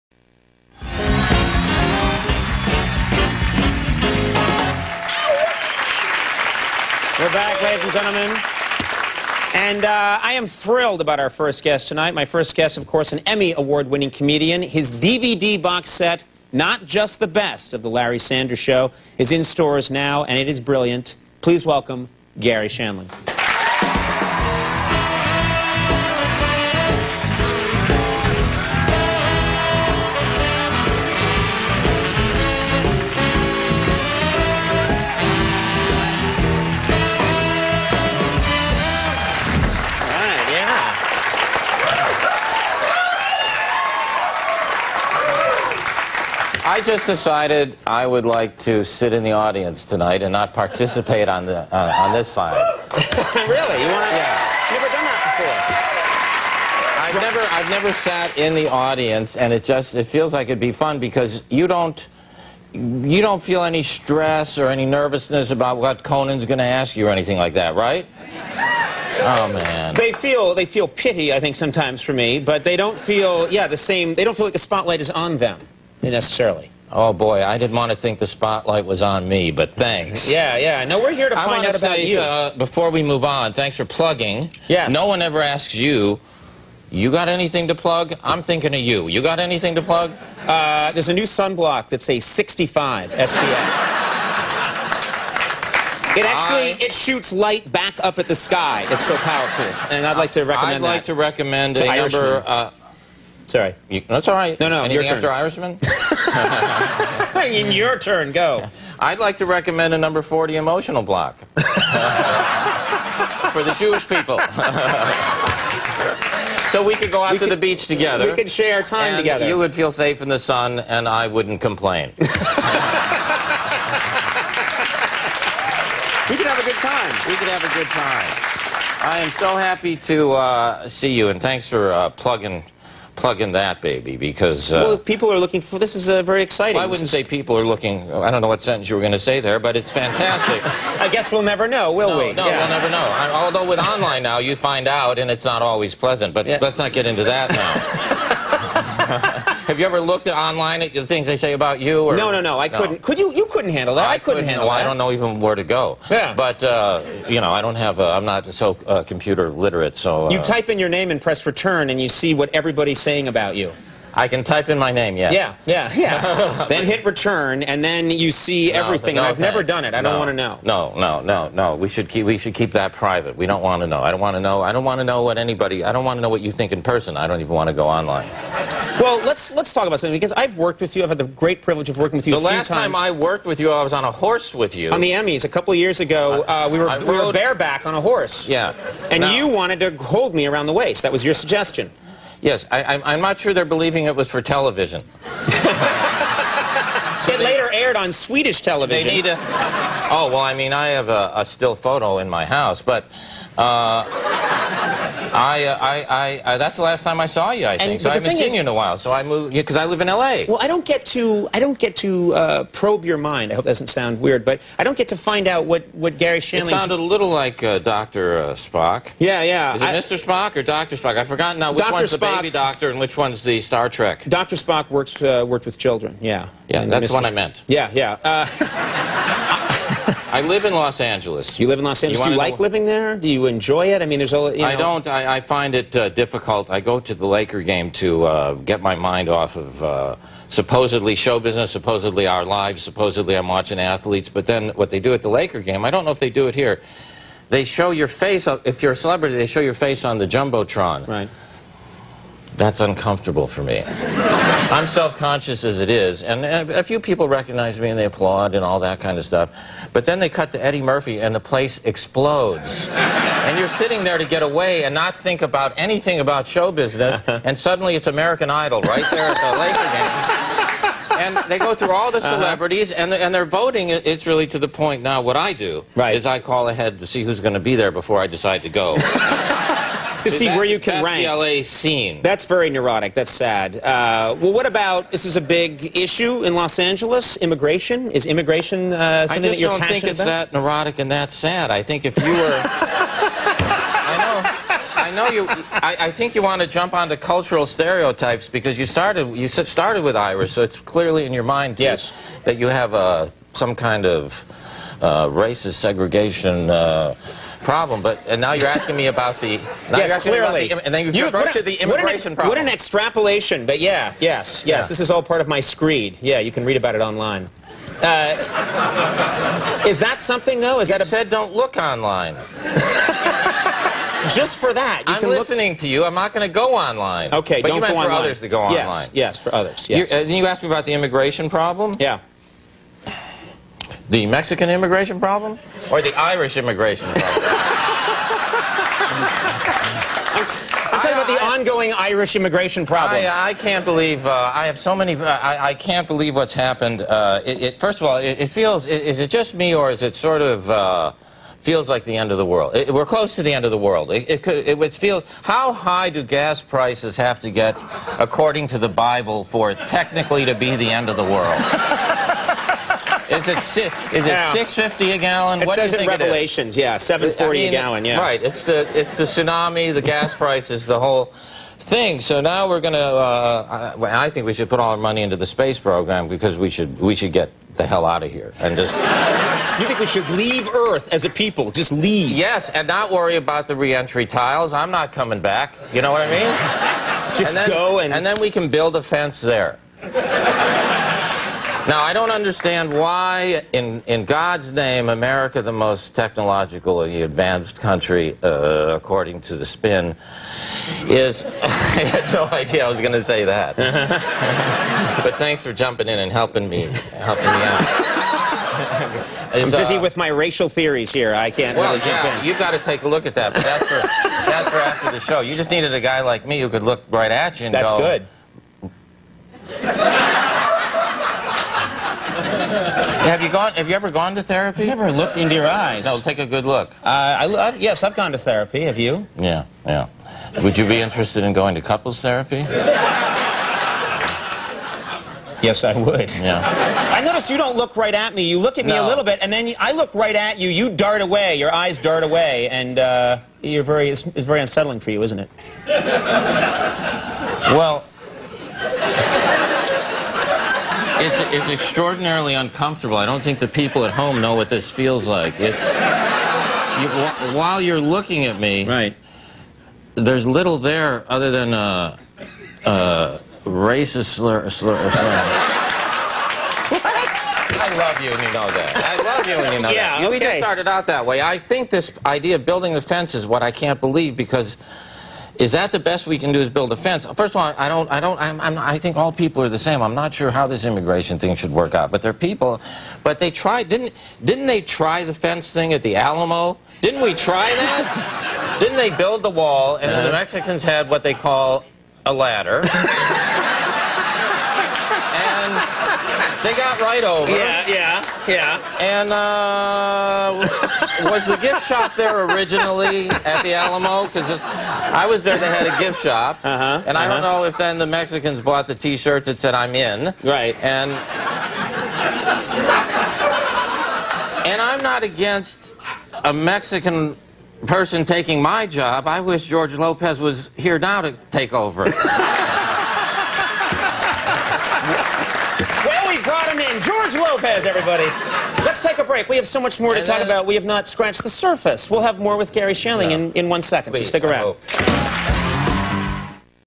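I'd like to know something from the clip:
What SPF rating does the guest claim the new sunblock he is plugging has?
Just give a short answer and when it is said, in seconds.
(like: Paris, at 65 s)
65, at 92 s.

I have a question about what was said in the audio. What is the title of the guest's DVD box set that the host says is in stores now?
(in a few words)
Not Just the Best of The Larry Sanders Show.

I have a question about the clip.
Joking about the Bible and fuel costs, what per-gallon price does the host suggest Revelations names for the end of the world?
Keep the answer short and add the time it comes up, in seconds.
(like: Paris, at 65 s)
$7.40, at 366 s.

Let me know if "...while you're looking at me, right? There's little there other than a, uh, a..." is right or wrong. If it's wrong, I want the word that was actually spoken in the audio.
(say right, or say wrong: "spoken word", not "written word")
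right.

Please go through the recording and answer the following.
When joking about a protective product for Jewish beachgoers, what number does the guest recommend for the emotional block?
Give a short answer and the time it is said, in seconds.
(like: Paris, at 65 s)
40, at 109 s.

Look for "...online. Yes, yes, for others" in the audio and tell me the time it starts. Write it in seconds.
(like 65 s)
328 s.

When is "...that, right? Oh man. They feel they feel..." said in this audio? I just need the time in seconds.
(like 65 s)
67 s.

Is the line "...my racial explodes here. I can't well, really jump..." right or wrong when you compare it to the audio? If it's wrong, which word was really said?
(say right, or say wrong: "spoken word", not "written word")
wrong: "theories", not "explodes".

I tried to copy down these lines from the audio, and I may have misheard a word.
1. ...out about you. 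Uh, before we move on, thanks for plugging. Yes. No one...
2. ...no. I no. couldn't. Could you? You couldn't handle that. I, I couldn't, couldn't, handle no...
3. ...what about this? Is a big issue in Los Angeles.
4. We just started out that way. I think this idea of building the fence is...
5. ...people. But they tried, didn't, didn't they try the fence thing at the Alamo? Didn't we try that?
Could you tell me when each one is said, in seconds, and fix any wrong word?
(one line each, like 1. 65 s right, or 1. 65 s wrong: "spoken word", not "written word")
1. 81 s right
2. 152 s right
3. 284 s right
4. 470 s right
5. 482 s right.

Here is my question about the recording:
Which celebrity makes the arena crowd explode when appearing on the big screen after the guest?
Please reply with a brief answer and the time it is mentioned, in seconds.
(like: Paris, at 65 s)
Eddie Murphy, at 260 s.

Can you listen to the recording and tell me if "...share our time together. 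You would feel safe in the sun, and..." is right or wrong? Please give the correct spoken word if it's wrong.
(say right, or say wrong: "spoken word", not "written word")
right.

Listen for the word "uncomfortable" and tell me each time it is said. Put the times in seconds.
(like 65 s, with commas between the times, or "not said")
252 s, 452 s.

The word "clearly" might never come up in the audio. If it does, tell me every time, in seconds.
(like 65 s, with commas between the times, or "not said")
300 s, 310 s.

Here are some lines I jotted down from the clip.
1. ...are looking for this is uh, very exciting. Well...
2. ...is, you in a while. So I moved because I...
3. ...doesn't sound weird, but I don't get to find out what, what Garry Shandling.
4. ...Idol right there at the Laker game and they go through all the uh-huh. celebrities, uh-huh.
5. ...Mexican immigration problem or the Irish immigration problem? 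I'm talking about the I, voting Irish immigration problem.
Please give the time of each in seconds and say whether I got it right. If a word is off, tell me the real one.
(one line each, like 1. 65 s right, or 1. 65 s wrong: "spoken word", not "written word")
1. 135 s right
2. 208 s right
3. 213 s right
4. 268 s right
5. 334 s wrong: "ongoing", not "voting".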